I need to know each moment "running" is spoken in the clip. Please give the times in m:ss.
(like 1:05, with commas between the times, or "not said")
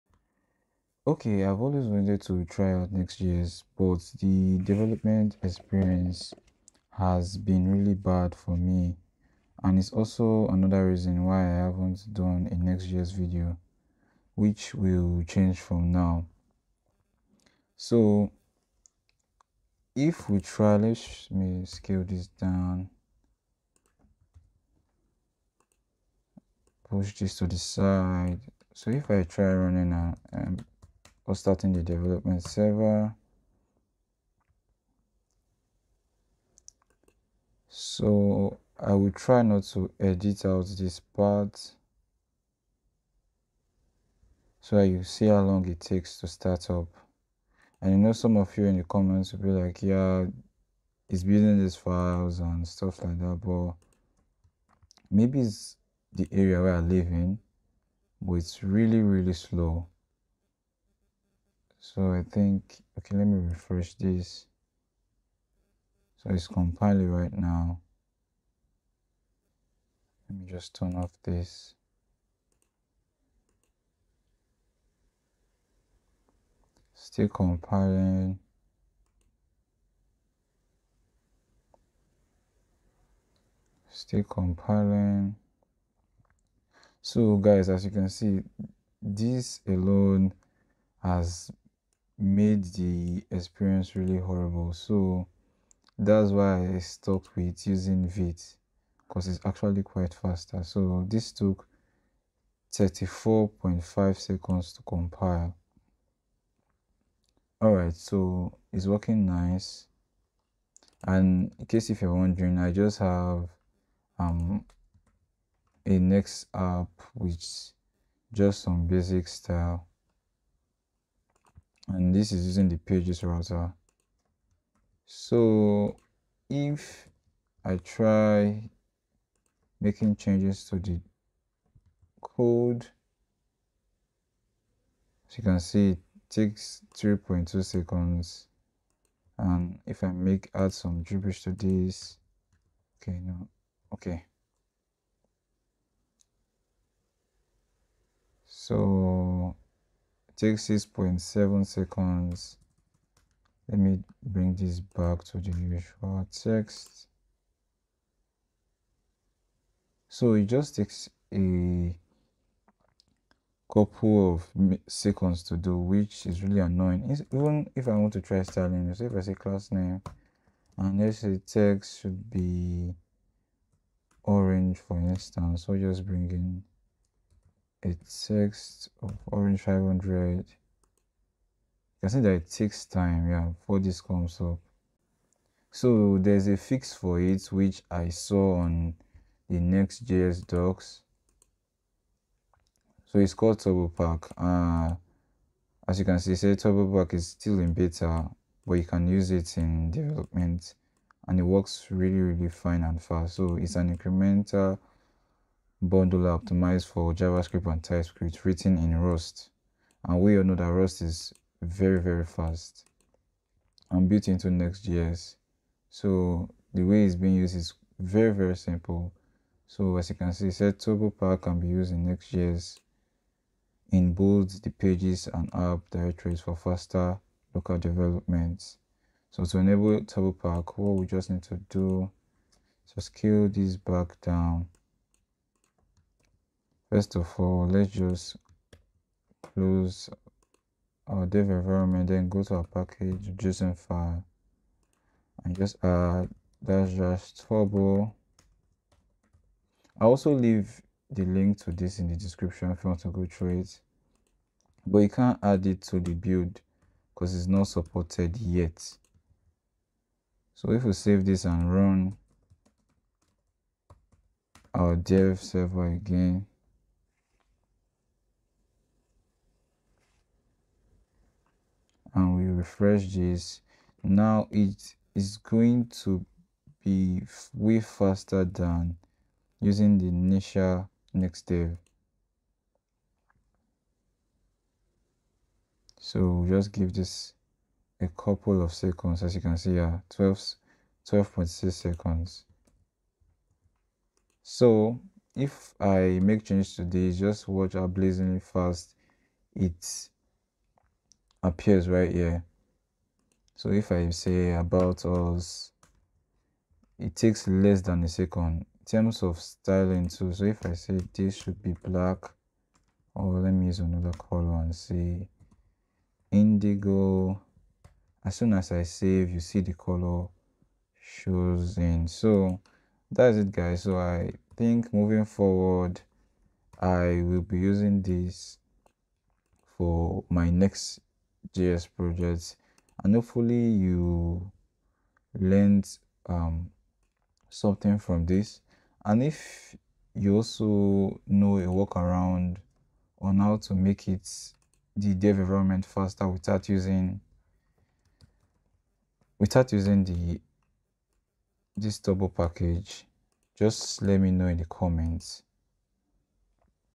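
0:29.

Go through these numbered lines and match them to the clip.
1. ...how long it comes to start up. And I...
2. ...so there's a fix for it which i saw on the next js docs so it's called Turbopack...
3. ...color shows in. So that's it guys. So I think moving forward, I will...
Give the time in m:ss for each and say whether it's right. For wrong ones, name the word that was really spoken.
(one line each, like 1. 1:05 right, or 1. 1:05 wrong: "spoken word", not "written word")
1. 0:45 wrong: "takes", not "comes"
2. 3:05 right
3. 5:19 right.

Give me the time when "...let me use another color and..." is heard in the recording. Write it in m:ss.
5:13.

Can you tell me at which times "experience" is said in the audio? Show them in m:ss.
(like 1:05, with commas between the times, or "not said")
0:05, 1:33.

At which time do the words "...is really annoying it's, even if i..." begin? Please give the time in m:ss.
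2:46.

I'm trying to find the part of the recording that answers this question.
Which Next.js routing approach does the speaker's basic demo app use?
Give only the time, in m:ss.
2:02.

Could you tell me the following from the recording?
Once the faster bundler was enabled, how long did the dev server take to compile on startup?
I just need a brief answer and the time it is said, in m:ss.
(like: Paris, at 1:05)
12.6 seconds, at 4:51.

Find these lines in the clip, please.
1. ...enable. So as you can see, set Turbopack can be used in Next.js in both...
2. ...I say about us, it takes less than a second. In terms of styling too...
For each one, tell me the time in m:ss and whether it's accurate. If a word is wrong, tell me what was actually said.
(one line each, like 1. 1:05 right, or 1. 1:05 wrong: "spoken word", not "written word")
1. 3:38 wrong: "simple", not "enable"
2. 5:03 right.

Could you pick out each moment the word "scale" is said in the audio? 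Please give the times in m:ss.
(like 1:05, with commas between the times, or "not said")
0:21, 3:53.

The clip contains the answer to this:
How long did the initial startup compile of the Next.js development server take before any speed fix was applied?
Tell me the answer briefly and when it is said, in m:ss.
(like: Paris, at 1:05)
34.5 seconds, at 1:42.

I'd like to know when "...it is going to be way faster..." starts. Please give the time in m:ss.
4:34.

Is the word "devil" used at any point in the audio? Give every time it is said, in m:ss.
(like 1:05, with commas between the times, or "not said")
not said.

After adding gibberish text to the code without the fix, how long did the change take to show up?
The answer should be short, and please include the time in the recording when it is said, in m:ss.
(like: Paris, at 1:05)
6.7 seconds, at 2:30.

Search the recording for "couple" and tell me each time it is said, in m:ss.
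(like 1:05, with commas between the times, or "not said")
2:43, 4:48.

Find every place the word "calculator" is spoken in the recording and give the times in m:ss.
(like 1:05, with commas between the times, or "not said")
not said.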